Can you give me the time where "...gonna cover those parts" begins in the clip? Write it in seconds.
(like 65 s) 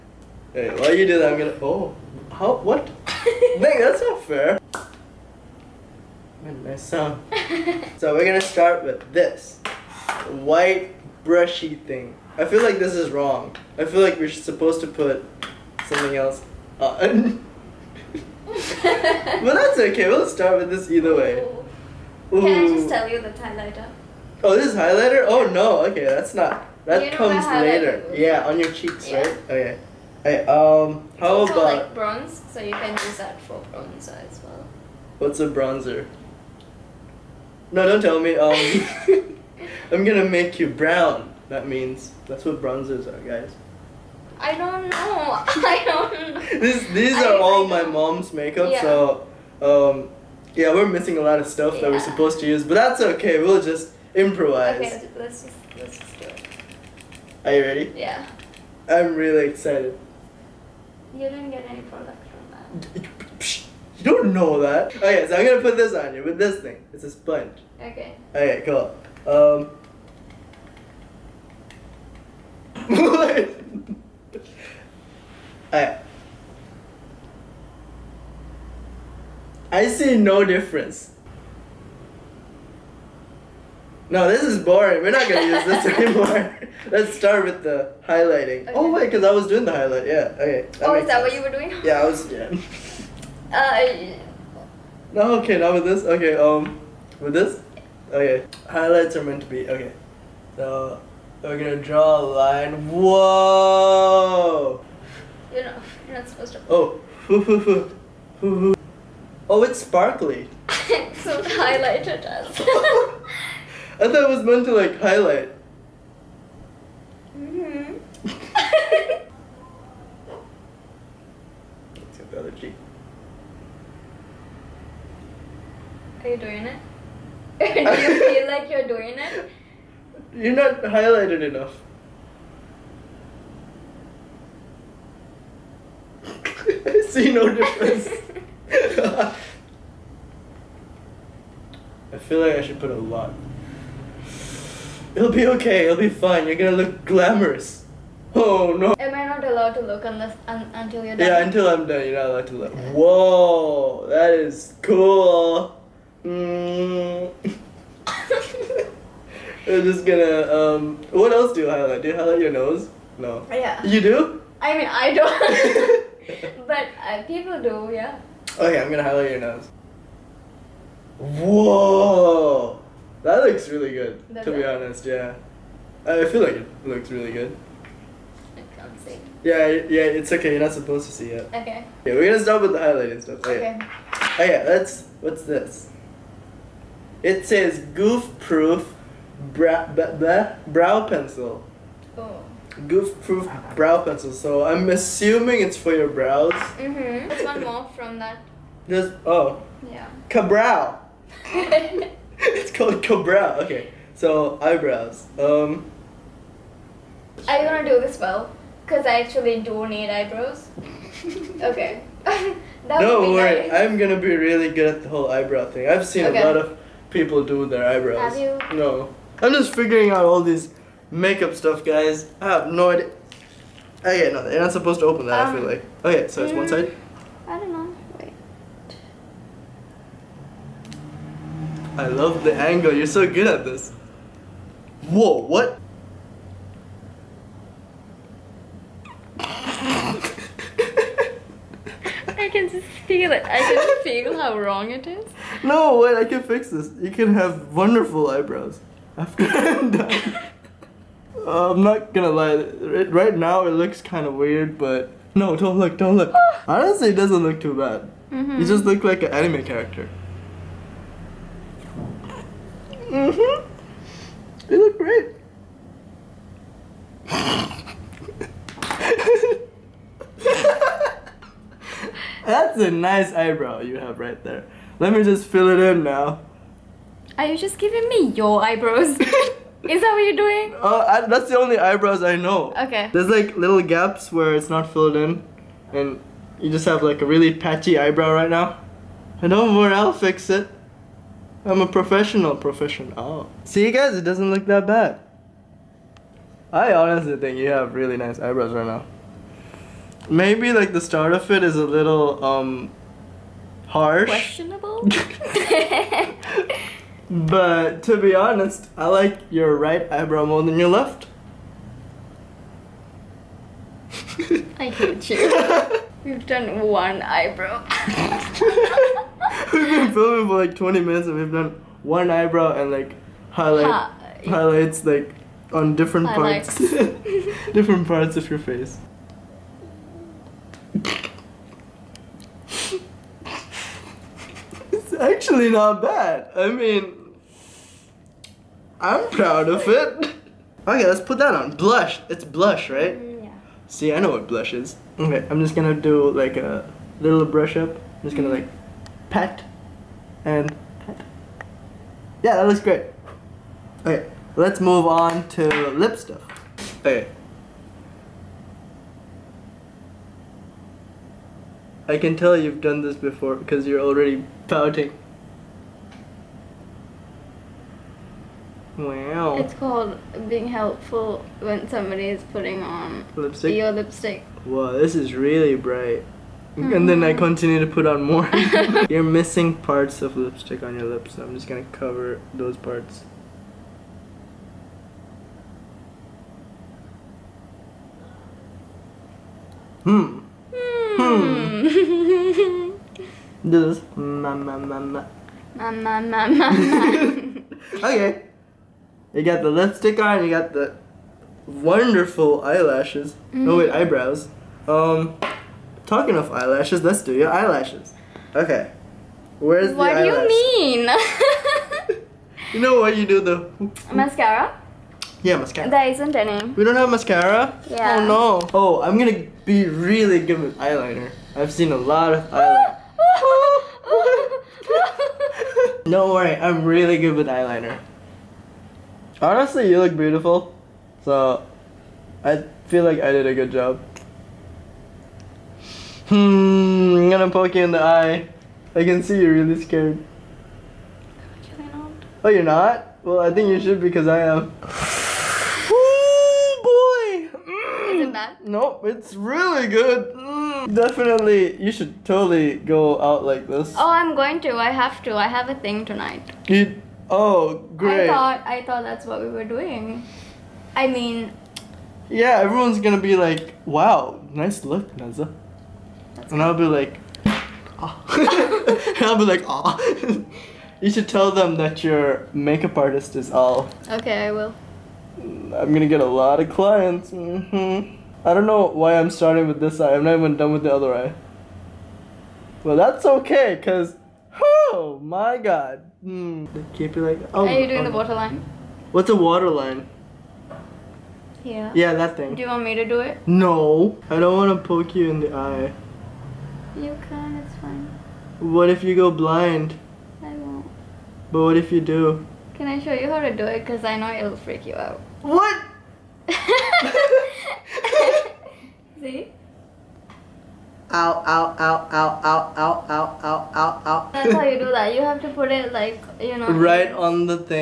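381 s.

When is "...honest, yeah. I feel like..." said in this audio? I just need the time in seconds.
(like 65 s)
174 s.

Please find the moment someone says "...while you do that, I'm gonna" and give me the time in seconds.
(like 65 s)
0 s.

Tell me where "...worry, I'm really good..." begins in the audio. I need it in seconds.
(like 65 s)
426 s.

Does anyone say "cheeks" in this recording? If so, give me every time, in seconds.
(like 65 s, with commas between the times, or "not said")
28 s, 122 s.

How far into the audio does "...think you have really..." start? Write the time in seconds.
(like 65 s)
297 s.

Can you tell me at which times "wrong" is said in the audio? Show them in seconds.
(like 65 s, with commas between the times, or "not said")
13 s, 244 s.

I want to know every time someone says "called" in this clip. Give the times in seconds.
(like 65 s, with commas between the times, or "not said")
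202 s, 369 s.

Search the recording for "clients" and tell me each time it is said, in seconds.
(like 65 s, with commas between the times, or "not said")
476 s.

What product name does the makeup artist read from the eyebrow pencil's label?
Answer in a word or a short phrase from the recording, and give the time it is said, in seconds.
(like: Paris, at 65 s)
Goof proof brow pencil, at 192 s.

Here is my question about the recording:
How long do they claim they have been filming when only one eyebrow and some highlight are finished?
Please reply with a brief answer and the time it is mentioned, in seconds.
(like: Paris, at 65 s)
20 minutes, at 320 s.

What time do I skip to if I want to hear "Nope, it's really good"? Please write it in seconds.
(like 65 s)
448 s.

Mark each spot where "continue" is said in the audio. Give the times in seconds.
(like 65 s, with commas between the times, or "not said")
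377 s.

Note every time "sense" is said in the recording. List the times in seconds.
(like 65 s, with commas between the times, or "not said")
91 s.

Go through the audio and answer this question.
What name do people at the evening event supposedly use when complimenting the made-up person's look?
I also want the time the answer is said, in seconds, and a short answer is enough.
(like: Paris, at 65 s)
Naza, at 465 s.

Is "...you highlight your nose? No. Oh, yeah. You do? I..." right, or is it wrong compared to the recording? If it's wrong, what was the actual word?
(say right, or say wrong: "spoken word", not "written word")
right.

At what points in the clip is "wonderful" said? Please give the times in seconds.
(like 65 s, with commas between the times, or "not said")
247 s, 401 s.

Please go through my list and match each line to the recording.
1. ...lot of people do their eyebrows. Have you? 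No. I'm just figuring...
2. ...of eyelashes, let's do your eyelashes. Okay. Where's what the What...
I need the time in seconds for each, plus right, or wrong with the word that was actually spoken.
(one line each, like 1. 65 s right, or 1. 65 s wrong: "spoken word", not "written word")
1. 216 s right
2. 406 s right.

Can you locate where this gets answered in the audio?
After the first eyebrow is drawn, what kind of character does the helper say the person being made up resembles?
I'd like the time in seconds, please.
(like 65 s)
259 s.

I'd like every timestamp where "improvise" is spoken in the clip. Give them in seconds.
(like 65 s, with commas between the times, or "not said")
54 s.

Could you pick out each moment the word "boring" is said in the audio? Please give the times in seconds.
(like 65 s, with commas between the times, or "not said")
84 s.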